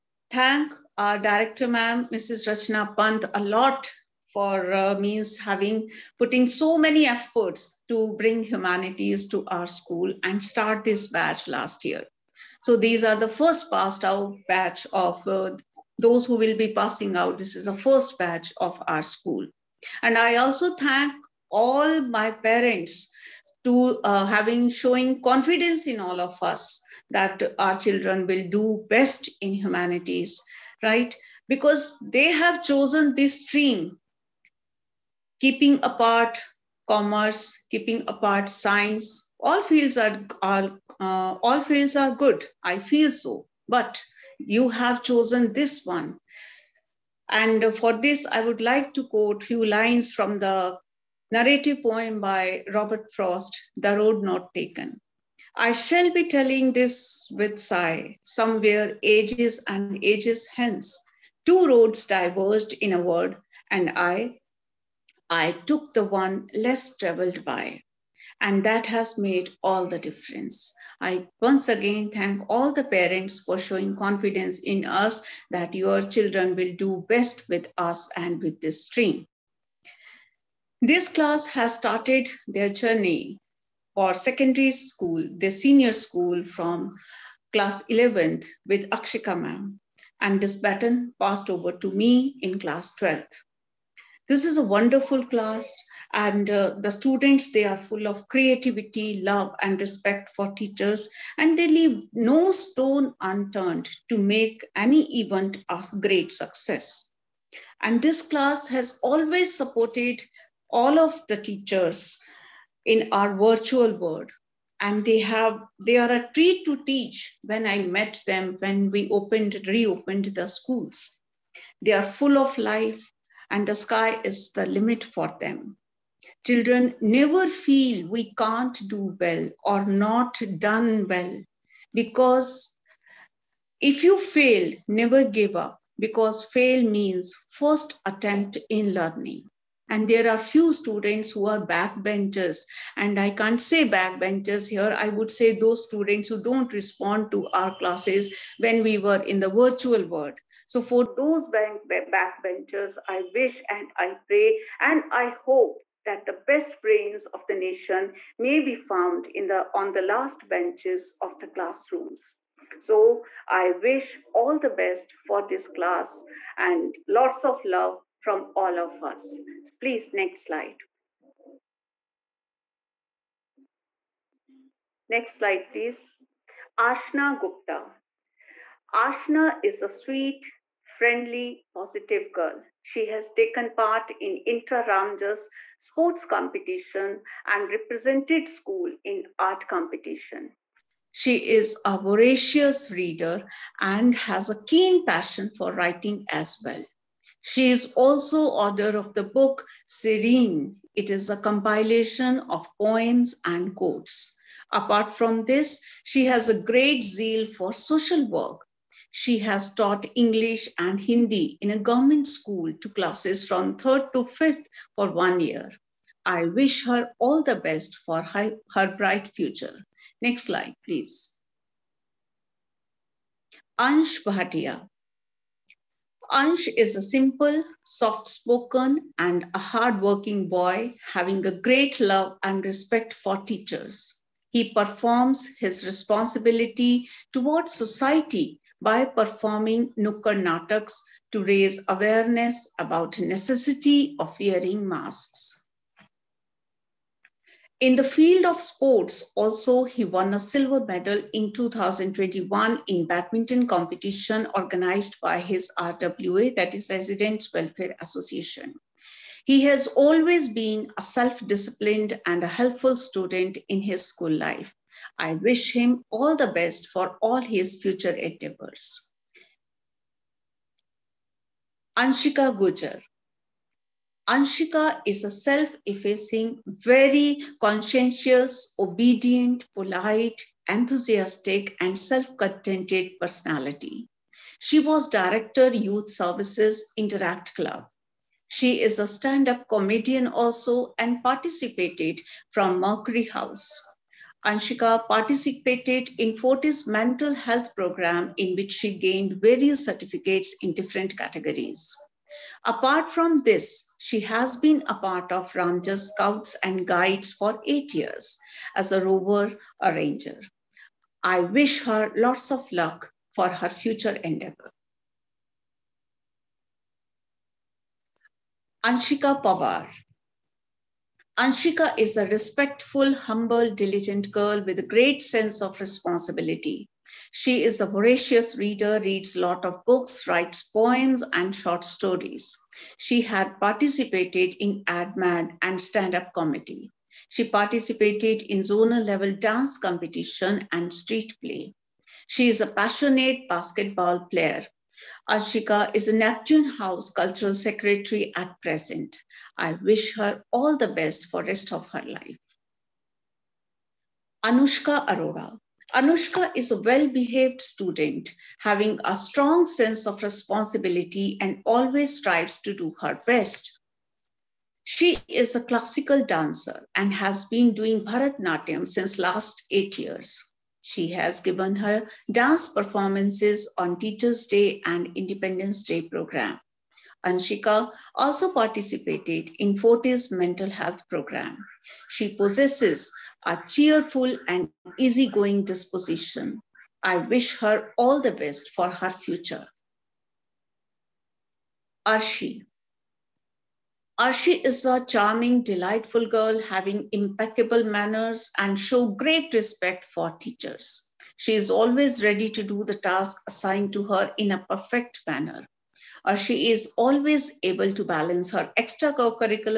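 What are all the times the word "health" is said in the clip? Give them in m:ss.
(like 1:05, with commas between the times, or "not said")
4:57, 6:20.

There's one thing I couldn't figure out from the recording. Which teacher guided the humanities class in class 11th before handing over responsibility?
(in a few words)
Akshika ma'am.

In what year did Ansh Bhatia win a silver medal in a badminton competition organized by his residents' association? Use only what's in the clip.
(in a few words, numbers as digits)
2021.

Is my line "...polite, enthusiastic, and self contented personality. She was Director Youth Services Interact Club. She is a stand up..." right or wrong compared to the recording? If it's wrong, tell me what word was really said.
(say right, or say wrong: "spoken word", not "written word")
right.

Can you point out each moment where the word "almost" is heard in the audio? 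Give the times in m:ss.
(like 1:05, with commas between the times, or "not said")
not said.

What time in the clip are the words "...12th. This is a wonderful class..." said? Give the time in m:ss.
1:32.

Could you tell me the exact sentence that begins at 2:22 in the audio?
And I can't say backbenchers here.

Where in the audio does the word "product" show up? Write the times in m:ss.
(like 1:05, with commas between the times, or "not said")
not said.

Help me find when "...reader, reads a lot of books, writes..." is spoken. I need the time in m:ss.
5:28.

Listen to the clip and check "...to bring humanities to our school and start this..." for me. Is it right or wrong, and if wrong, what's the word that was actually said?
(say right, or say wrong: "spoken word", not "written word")
right.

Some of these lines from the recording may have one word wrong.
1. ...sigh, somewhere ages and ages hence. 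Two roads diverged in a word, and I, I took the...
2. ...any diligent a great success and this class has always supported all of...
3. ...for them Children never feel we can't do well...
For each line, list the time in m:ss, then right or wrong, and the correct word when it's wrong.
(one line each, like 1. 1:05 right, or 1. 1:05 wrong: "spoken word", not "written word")
1. 0:57 right
2. 1:44 wrong: "event", not "diligent"
3. 2:05 right.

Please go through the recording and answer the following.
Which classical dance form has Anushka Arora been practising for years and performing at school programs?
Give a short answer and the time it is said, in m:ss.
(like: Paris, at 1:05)
Bharatnatyam, at 6:08.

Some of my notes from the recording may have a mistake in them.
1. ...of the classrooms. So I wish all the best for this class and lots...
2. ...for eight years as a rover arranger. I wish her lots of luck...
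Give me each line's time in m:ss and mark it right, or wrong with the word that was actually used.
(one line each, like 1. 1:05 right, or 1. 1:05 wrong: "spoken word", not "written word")
1. 2:41 right
2. 5:07 right.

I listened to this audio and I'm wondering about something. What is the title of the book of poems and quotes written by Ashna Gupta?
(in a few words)
Serene.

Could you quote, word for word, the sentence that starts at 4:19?
He has always been a self disciplined and a helpful student in his school life.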